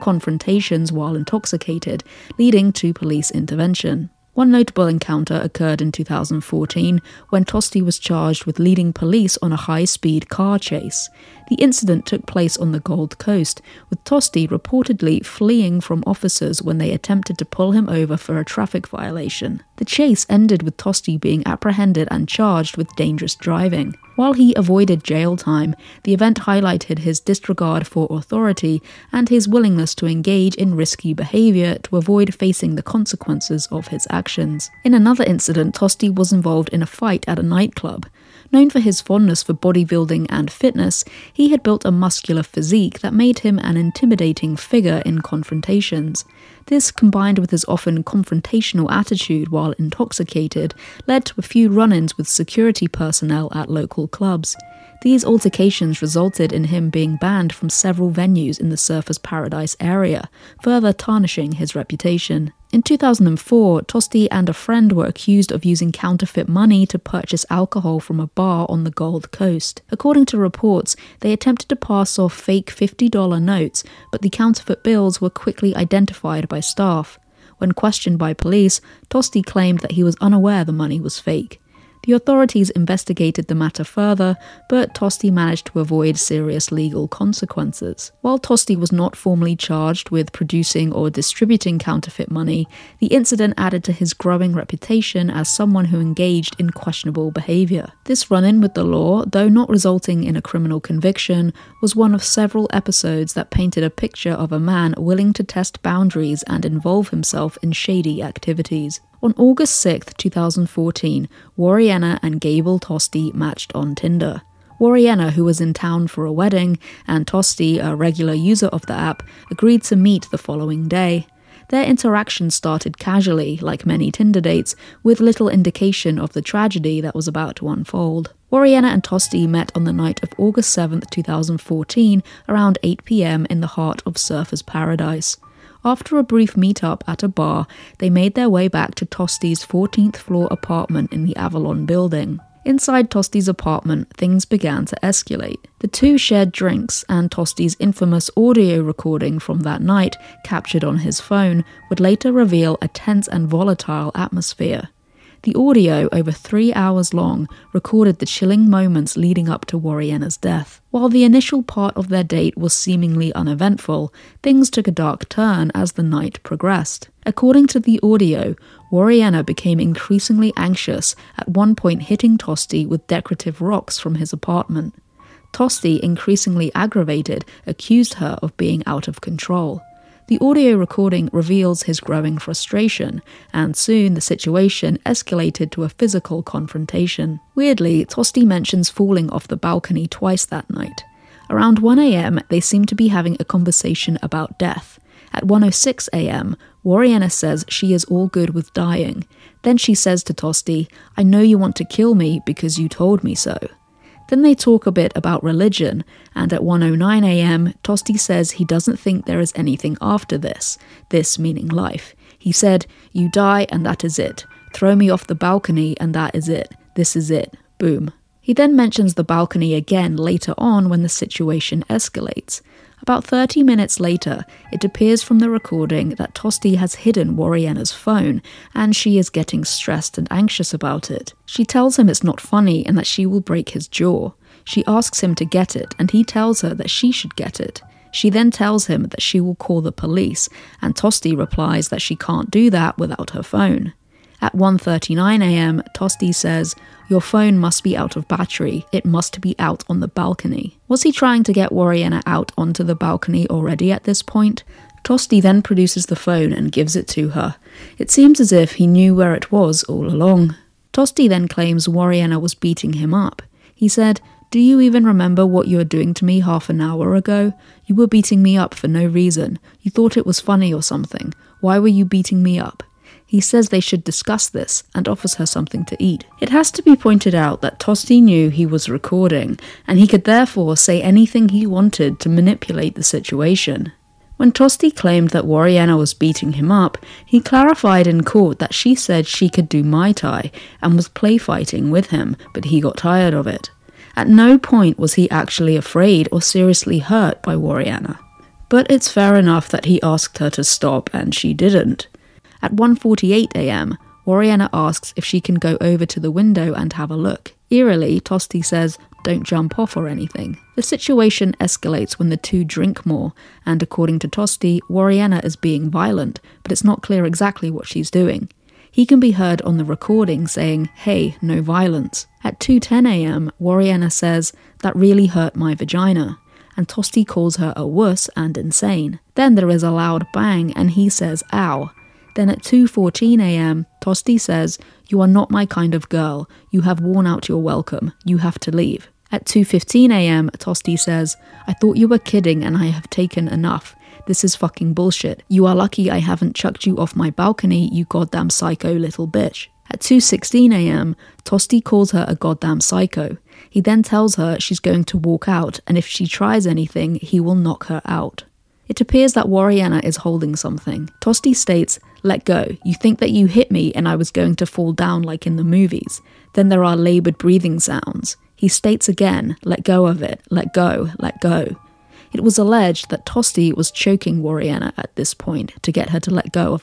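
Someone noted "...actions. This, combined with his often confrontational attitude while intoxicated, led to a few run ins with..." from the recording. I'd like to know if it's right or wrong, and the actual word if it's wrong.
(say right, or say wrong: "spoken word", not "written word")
wrong: "confrontations", not "actions".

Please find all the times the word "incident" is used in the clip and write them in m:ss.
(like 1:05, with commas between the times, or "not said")
0:11, 0:35, 1:33.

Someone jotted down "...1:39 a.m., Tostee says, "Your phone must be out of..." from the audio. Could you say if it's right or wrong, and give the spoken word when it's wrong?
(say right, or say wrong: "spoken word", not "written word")
right.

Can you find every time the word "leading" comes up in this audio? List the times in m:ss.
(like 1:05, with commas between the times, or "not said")
0:02, 0:08, 2:39.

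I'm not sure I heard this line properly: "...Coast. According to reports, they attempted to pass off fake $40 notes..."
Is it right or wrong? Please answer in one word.
wrong.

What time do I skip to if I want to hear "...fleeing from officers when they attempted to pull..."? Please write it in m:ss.
0:15.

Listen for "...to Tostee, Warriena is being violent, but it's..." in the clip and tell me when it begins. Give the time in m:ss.
5:14.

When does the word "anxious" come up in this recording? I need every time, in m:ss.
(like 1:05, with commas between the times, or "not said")
2:50, 3:50.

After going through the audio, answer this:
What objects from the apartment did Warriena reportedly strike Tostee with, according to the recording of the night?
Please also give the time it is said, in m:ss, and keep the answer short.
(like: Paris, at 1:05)
decorative rocks, at 2:53.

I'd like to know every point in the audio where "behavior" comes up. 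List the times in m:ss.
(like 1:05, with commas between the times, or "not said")
0:31, 1:37.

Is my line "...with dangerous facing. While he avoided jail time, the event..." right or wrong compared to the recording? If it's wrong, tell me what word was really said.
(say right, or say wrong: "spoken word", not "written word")
wrong: "driving", not "facing".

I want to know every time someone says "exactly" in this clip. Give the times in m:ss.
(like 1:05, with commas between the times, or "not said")
5:17.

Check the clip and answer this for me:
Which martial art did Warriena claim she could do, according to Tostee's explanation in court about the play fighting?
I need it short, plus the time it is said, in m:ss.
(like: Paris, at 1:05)
Muay Thai, at 4:49.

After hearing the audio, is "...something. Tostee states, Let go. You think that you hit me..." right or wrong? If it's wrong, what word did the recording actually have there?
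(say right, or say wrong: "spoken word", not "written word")
right.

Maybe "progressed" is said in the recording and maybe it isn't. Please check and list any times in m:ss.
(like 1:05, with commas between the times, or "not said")
2:46.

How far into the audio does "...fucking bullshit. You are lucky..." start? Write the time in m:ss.
5:44.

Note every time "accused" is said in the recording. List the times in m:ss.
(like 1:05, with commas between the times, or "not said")
1:05, 2:57.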